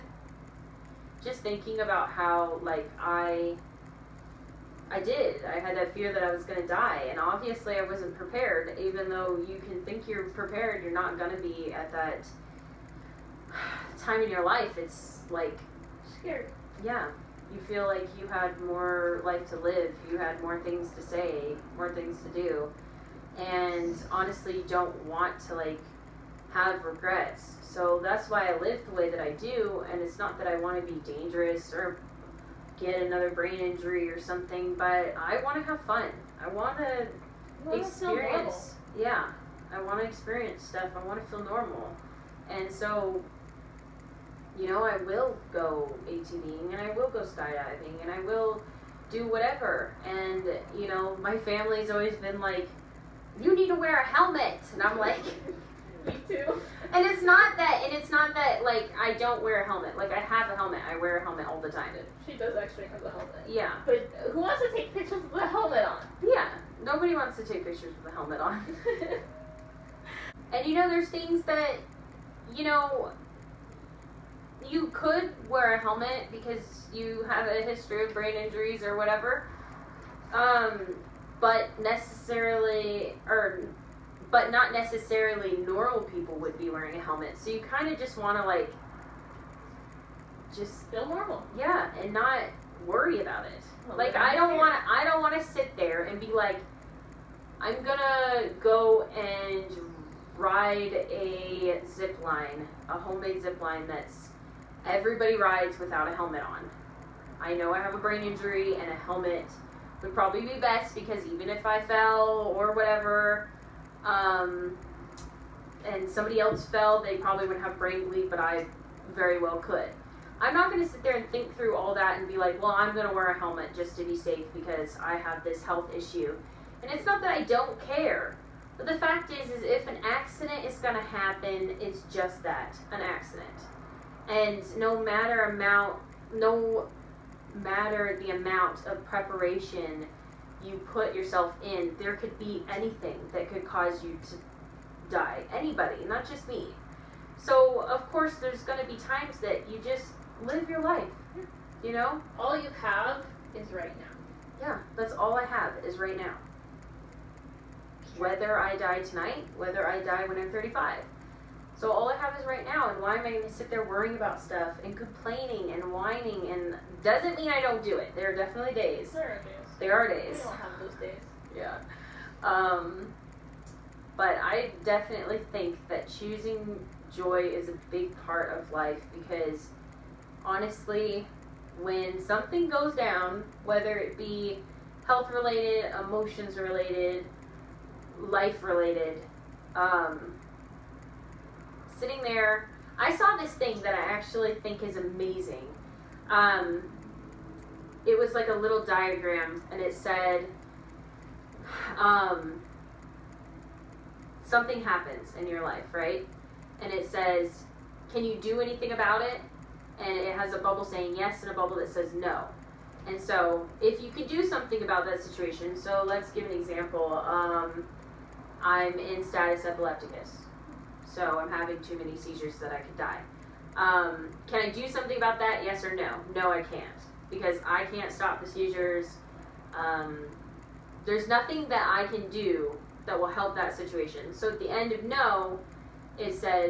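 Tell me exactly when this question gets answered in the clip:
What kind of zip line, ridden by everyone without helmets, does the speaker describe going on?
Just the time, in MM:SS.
01:42.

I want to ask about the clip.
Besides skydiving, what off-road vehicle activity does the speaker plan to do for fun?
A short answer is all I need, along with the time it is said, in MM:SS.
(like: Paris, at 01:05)
ATVing, at 00:46.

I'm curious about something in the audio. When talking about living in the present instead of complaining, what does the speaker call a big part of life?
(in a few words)
choosing joy.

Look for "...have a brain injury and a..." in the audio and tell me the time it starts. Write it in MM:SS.
01:47.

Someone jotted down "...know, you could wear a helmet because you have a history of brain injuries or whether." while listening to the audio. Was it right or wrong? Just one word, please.
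wrong.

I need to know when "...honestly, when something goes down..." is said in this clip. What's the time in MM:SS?
03:00.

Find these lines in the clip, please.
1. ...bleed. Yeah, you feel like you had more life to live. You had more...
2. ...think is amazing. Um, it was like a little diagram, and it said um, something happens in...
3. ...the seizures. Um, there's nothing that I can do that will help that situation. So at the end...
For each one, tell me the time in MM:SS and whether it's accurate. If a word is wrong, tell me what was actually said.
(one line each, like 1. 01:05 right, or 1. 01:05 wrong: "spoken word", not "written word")
1. 00:16 wrong: "scared", not "bleed"
2. 03:14 right
3. 03:48 right.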